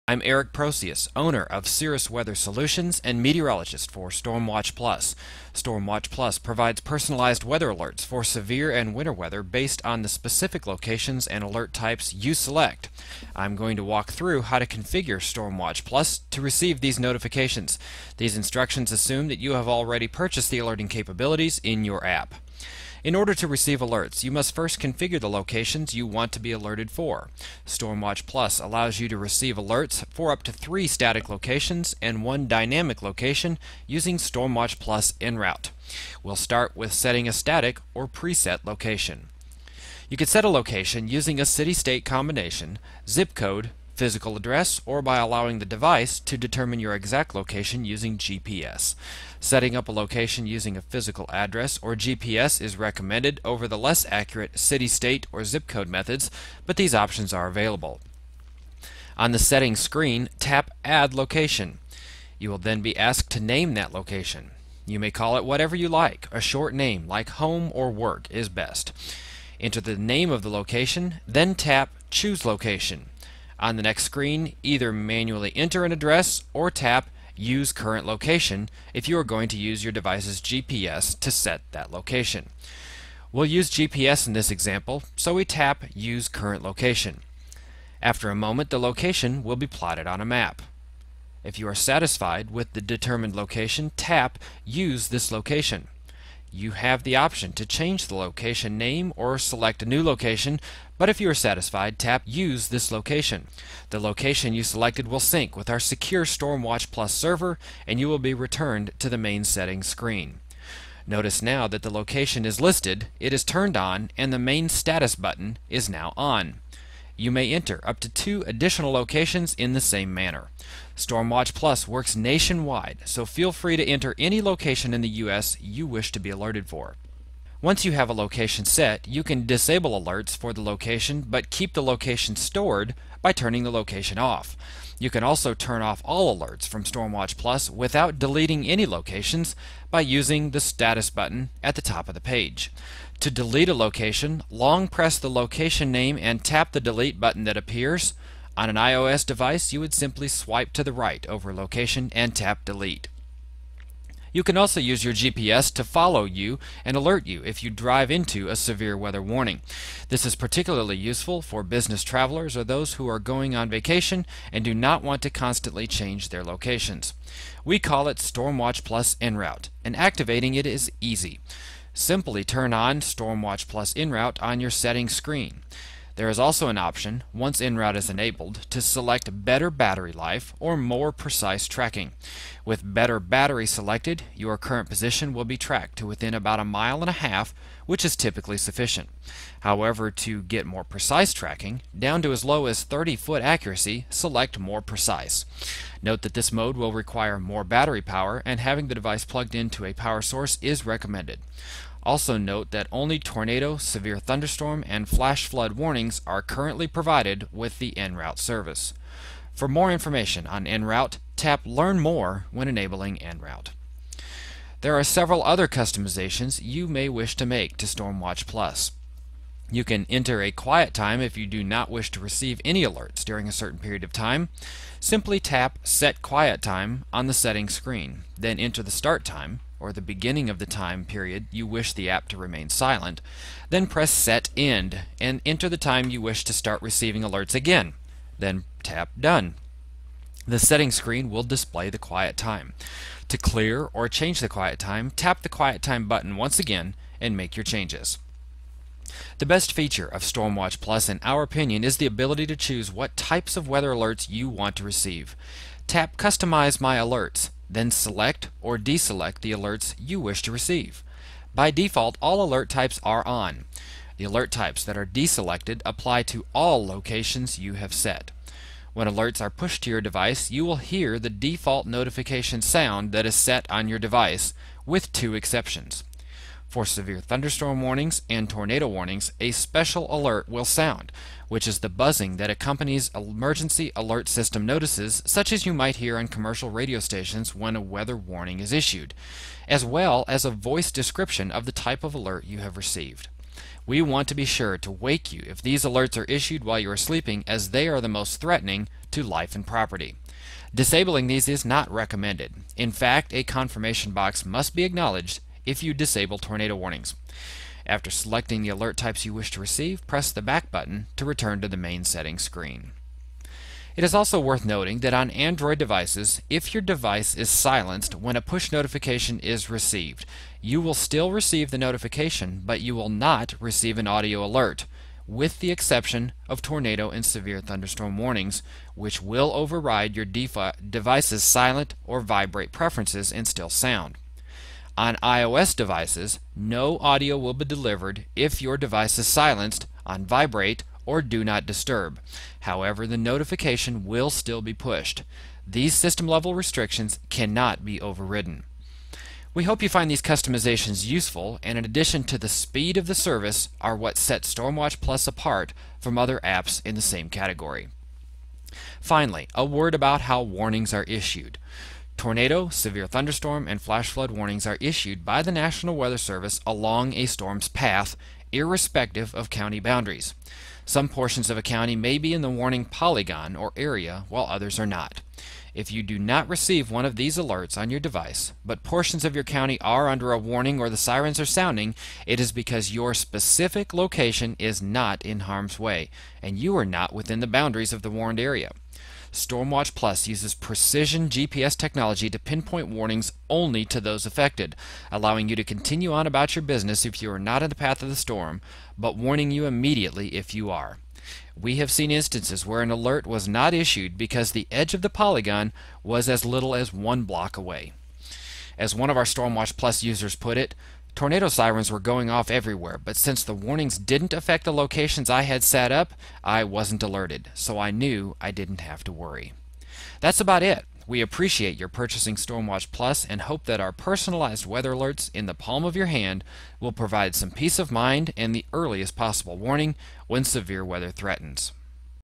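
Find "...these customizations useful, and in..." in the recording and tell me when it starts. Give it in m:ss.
5:50.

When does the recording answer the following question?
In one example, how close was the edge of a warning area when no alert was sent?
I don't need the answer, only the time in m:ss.
6:46.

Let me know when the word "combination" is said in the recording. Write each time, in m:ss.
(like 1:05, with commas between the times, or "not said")
0:42.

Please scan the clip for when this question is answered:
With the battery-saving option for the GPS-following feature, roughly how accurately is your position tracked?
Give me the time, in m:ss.
3:06.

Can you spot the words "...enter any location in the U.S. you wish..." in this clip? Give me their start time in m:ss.
2:03.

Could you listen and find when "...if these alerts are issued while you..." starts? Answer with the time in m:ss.
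4:55.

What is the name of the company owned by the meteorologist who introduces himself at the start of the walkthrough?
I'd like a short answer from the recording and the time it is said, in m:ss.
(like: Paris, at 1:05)
Cirrus Weather Solutions, at 0:01.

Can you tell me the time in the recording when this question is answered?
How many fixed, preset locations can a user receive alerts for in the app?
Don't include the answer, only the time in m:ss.
0:30.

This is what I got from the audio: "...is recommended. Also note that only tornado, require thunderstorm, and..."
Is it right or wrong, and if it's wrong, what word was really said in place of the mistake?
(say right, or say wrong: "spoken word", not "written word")
wrong: "severe", not "require".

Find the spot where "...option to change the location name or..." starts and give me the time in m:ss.
1:37.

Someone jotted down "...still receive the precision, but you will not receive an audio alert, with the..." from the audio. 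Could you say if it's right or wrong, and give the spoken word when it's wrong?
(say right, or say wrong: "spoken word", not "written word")
wrong: "notification", not "precision".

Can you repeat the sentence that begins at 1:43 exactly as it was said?
The location you selected will sync with our secure Stormwatch Plus server, and you will be returned to the main settings screen.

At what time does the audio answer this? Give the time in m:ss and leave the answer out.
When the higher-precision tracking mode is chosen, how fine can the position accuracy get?
3:12.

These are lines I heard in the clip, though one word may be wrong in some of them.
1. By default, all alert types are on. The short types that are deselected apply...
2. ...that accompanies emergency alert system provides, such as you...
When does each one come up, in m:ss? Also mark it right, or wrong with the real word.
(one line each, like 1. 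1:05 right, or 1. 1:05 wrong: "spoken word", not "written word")
1. 4:21 wrong: "alert", not "short"
2. 4:42 wrong: "notices", not "provides".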